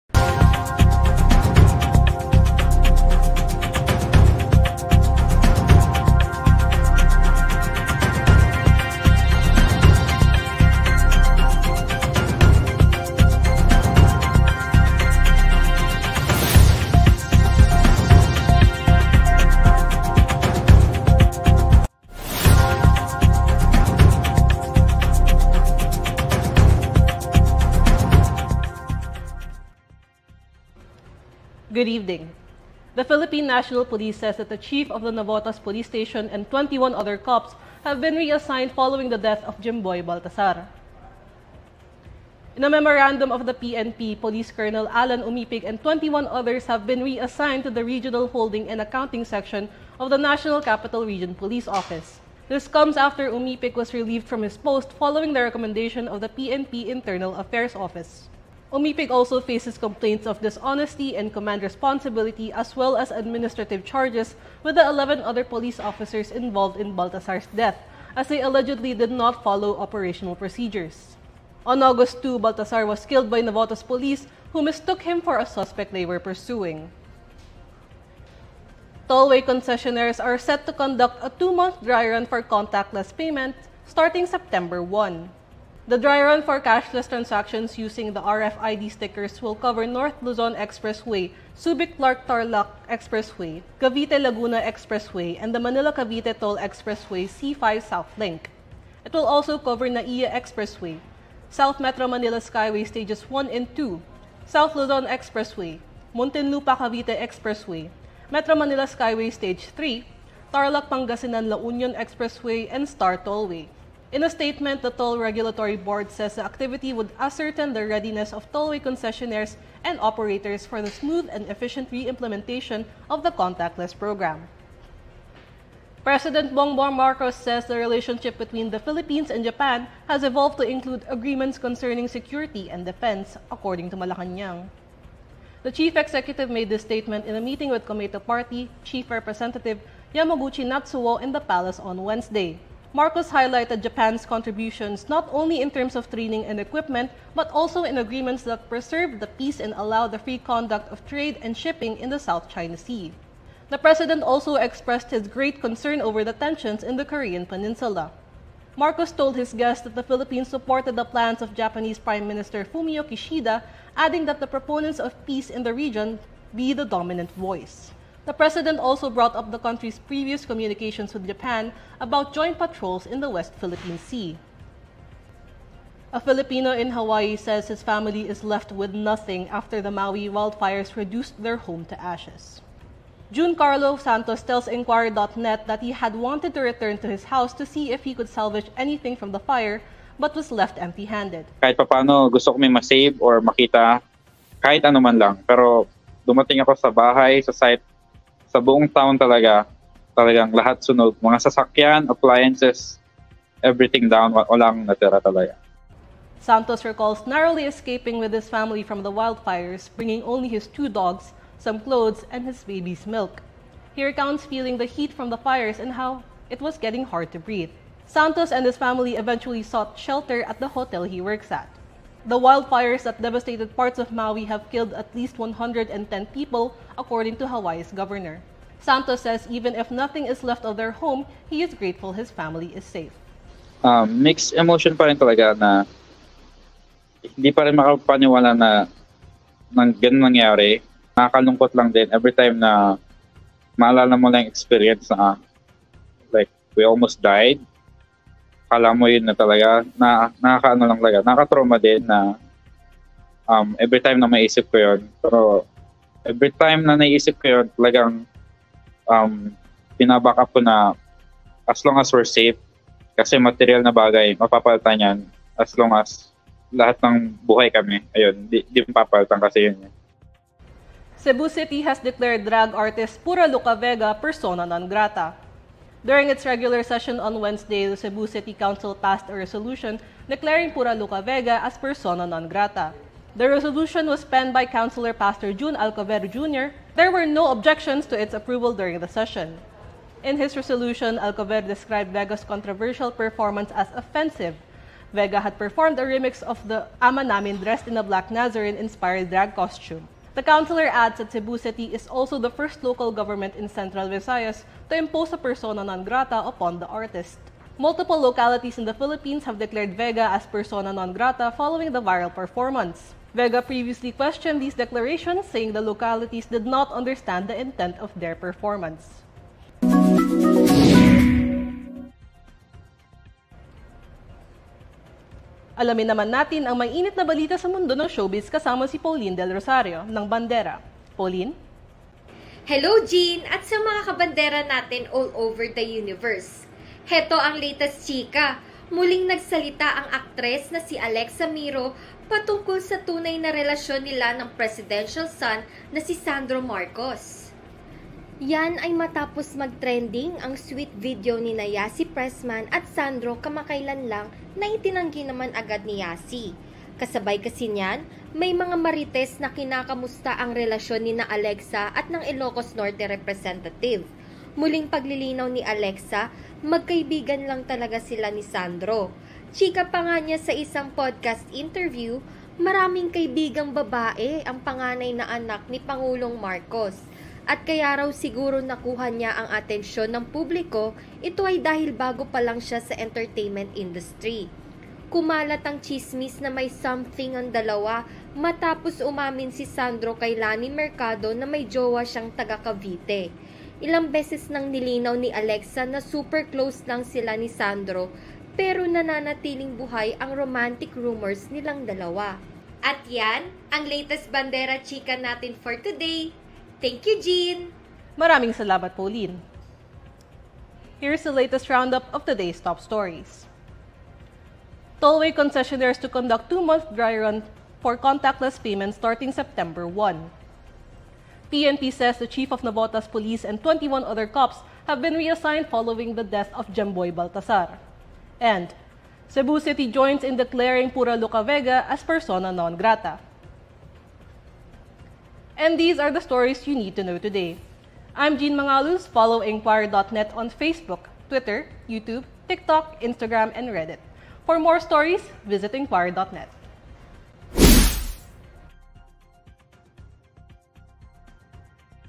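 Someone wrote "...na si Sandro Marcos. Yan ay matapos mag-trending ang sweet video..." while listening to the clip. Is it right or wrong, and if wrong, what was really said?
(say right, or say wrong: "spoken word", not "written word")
right.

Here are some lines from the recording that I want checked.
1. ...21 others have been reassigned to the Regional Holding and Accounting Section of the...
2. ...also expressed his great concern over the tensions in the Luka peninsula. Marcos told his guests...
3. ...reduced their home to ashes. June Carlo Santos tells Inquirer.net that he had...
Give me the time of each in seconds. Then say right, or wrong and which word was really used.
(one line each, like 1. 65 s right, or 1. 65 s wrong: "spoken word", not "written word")
1. 45 s right
2. 154 s wrong: "Korean", not "Luka"
3. 180 s right.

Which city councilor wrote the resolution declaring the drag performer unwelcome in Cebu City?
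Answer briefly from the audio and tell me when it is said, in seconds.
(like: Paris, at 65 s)
Pastor June Alcovero Jr., at 285 s.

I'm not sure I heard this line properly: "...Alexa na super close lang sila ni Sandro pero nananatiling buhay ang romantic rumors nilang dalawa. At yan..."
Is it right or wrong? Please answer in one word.
right.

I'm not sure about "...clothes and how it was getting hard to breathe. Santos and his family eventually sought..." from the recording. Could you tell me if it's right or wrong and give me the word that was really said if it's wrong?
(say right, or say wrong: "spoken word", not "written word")
wrong: "fires", not "clothes".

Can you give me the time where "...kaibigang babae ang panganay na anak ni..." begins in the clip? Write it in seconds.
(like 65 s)
373 s.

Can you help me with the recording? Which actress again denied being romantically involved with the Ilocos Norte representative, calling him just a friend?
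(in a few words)
Alexa Miro.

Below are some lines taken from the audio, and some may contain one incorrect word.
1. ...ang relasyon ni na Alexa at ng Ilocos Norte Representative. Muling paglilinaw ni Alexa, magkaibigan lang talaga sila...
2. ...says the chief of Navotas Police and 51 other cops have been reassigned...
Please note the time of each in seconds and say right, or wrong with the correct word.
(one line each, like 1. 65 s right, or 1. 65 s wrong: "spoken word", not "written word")
1. 360 s right
2. 421 s wrong: "21", not "51".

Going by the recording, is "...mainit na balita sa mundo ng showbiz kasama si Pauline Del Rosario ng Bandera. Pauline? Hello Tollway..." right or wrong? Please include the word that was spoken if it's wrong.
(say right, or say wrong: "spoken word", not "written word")
wrong: "Jean", not "Tollway".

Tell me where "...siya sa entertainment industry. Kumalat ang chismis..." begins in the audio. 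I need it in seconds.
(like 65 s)
382 s.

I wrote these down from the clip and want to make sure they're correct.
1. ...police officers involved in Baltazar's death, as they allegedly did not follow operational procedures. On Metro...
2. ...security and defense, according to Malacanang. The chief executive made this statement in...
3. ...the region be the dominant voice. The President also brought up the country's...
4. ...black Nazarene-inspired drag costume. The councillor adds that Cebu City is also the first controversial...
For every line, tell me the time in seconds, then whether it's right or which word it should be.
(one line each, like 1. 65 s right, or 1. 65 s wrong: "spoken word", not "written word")
1. 65 s wrong: "August", not "Metro"
2. 132 s right
3. 165 s right
4. 298 s wrong: "local", not "controversial".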